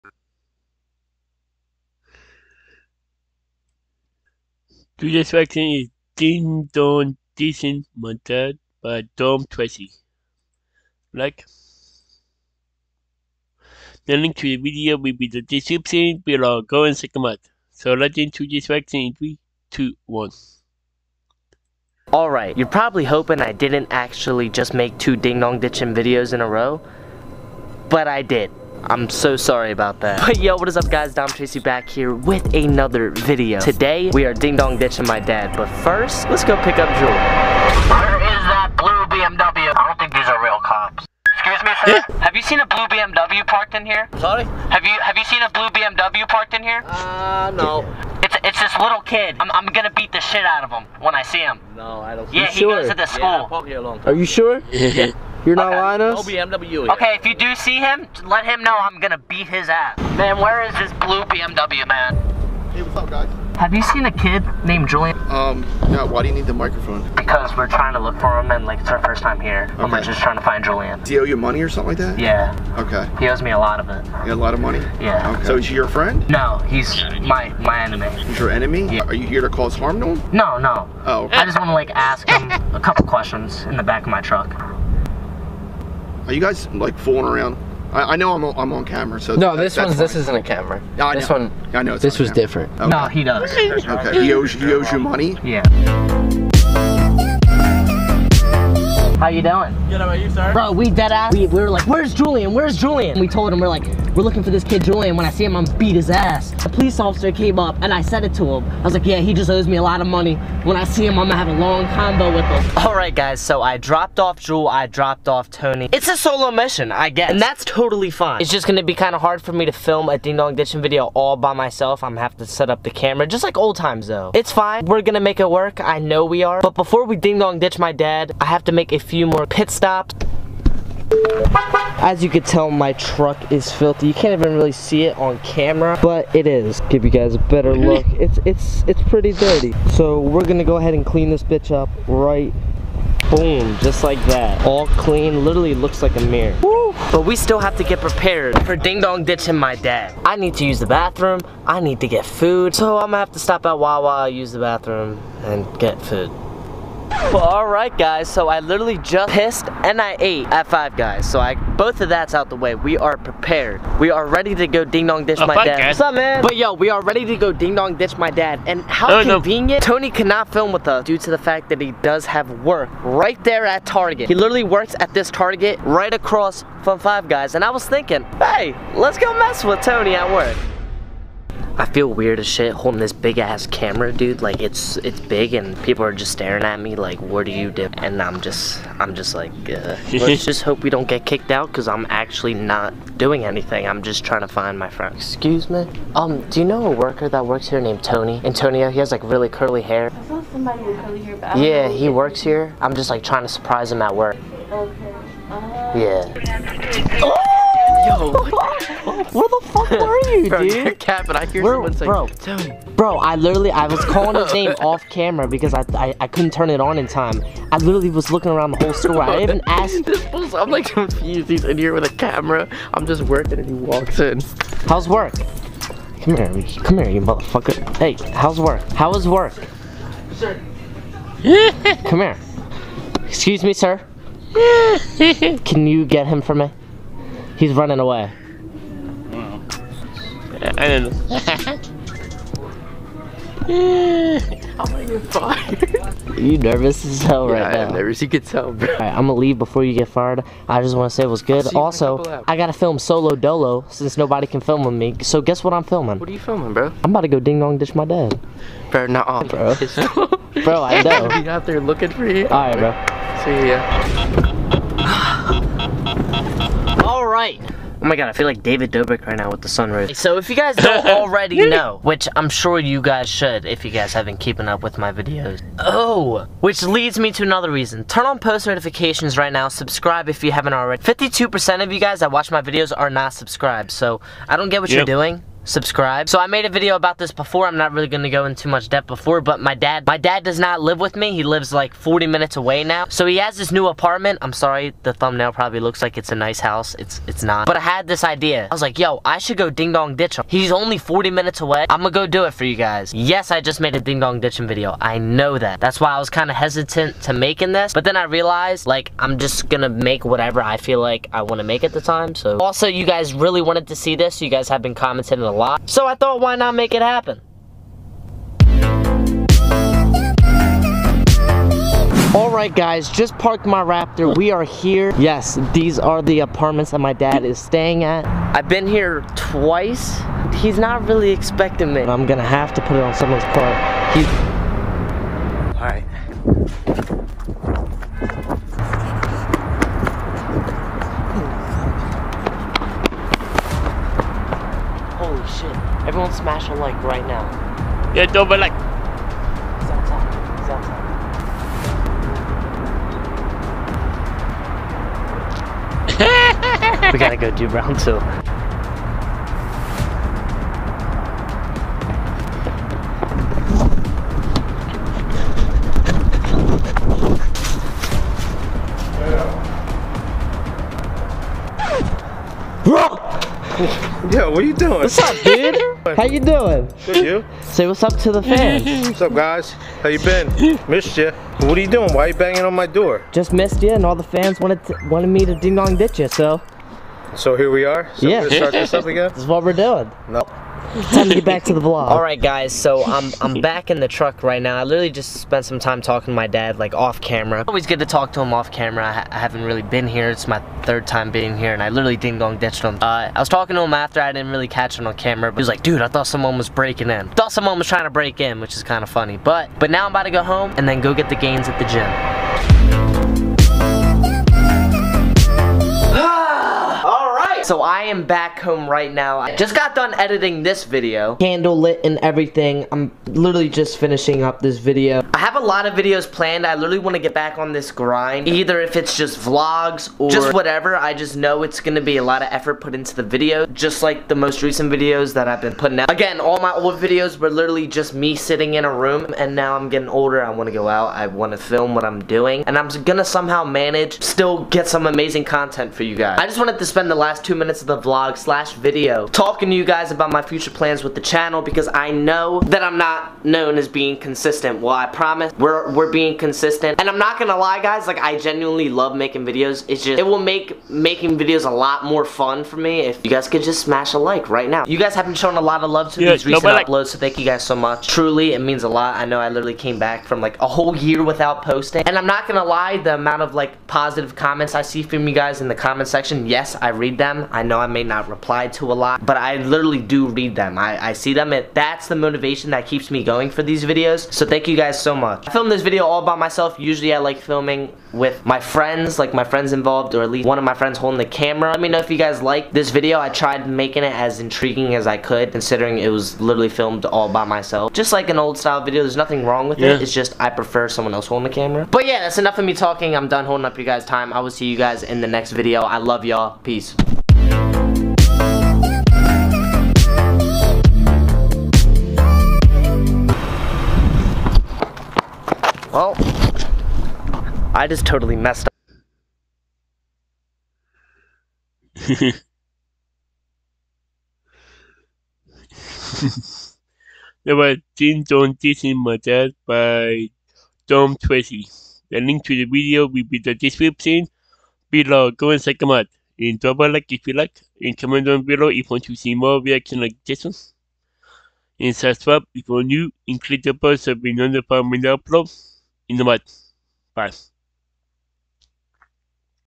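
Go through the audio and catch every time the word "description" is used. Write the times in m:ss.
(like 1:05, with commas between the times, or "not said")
0:15, 8:53.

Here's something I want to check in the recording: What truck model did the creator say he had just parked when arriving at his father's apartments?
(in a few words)
Raptor.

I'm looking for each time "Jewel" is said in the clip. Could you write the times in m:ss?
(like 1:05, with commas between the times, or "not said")
0:36, 1:54.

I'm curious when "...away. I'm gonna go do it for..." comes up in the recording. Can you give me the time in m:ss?
5:01.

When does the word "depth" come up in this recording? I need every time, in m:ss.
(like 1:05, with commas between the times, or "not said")
4:48.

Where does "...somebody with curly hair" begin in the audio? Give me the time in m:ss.
3:20.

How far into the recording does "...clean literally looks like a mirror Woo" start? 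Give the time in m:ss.
2:24.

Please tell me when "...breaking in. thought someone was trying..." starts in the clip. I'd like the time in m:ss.
6:46.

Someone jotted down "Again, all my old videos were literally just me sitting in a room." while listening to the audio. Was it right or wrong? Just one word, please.
right.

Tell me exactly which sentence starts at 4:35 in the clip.
Oh, which leads me to another reason.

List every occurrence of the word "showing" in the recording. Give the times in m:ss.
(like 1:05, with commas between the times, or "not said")
7:45.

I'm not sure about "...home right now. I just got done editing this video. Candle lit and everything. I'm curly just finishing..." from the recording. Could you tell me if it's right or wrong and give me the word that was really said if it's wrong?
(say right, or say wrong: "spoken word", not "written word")
wrong: "literally", not "curly".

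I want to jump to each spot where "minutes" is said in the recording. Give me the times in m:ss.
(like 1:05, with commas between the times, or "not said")
4:52, 5:01, 7:27.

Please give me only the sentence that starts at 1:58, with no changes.
It's just gonna be kind of hard for me to film a Ding Dong Ditching video all by myself.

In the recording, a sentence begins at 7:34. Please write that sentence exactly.
Well, I promise we're, we're being consistent.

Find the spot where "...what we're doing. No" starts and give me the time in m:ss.
6:29.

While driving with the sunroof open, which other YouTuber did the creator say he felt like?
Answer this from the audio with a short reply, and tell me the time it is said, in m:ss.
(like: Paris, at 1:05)
David Dobrik, at 4:28.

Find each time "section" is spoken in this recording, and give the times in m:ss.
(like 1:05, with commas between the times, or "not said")
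0:05, 0:18, 7:56.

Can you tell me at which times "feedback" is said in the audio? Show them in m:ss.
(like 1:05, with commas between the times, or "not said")
not said.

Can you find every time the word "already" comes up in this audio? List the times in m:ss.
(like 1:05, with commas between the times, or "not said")
4:31, 4:40.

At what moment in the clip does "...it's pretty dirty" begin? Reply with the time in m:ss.
2:18.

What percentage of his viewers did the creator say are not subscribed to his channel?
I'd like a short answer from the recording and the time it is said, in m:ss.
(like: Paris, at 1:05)
52%, at 4:41.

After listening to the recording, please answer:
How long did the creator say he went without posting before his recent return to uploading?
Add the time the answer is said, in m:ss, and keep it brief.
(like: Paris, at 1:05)
a whole year, at 7:50.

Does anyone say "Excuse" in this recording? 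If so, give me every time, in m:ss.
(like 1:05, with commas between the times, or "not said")
0:41, 3:15, 3:53.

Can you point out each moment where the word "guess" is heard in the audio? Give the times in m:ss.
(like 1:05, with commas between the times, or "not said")
1:57, 4:15.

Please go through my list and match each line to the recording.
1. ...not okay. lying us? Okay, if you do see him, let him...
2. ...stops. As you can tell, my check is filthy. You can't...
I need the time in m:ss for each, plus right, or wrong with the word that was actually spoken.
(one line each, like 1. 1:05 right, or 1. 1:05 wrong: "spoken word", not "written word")
1. 0:55 right
2. 2:09 wrong: "truck", not "check".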